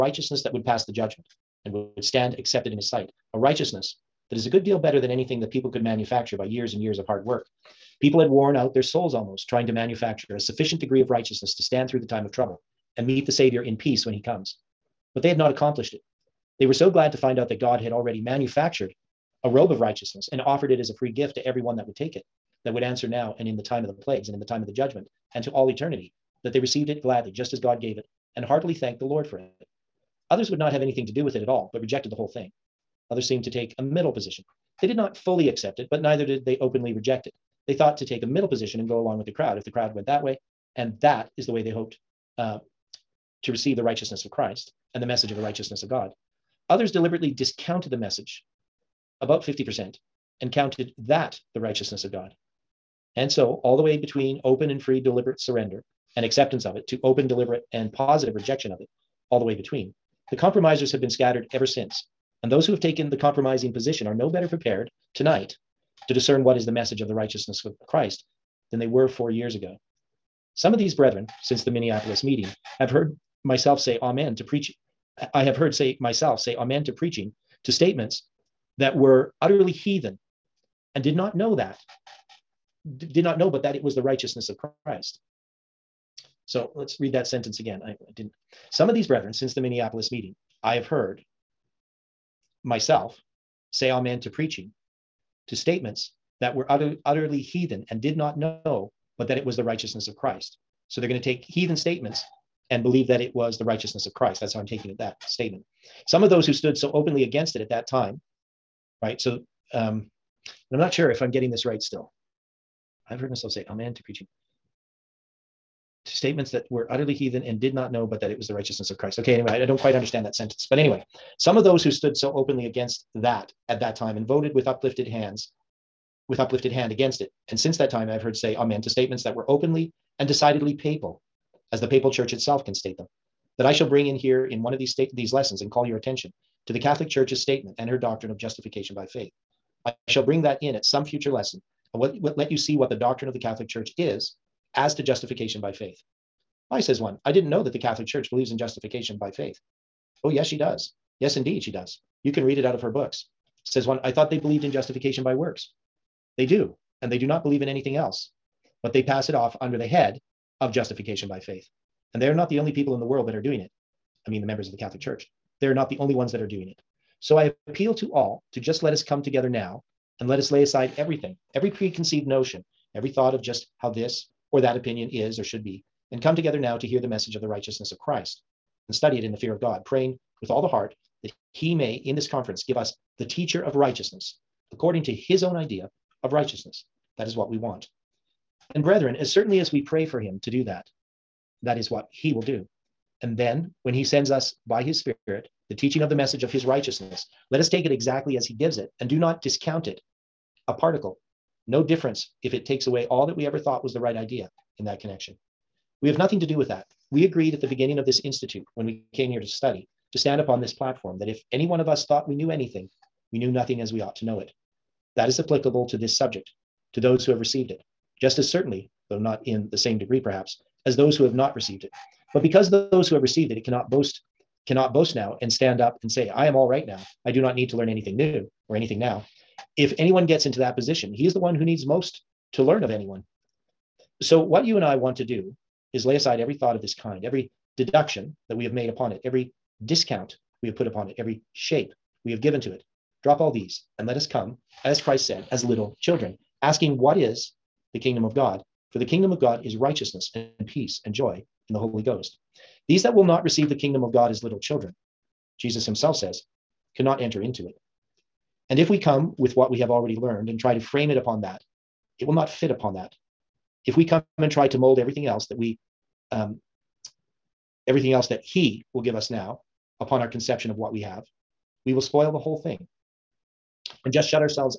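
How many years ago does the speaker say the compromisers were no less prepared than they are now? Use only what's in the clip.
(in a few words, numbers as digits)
4.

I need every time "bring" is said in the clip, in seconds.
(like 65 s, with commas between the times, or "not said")
133 s, 140 s.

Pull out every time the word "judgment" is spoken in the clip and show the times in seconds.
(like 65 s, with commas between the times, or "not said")
0 s, 24 s.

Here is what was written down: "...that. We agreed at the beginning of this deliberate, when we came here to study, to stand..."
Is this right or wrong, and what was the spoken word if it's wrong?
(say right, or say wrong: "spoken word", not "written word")
wrong: "institute", not "deliberate".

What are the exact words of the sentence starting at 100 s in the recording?
So they're going to take heathen statements and believe that it was the righteousness of Christ.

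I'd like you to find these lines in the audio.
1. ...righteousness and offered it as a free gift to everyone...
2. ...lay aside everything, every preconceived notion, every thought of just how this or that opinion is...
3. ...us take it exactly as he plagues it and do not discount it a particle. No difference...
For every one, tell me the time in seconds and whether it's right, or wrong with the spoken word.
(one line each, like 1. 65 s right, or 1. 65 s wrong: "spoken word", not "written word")
1. 19 s right
2. 170 s right
3. 197 s wrong: "gives", not "plagues".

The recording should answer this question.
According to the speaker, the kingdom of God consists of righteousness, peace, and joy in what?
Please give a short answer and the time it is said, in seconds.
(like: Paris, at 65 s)
the Holy Ghost, at 251 s.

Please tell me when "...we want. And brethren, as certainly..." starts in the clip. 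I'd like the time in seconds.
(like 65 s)
187 s.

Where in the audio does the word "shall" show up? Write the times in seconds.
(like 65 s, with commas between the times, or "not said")
133 s, 140 s.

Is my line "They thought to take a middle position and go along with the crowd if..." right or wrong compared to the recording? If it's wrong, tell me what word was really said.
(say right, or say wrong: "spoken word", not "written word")
right.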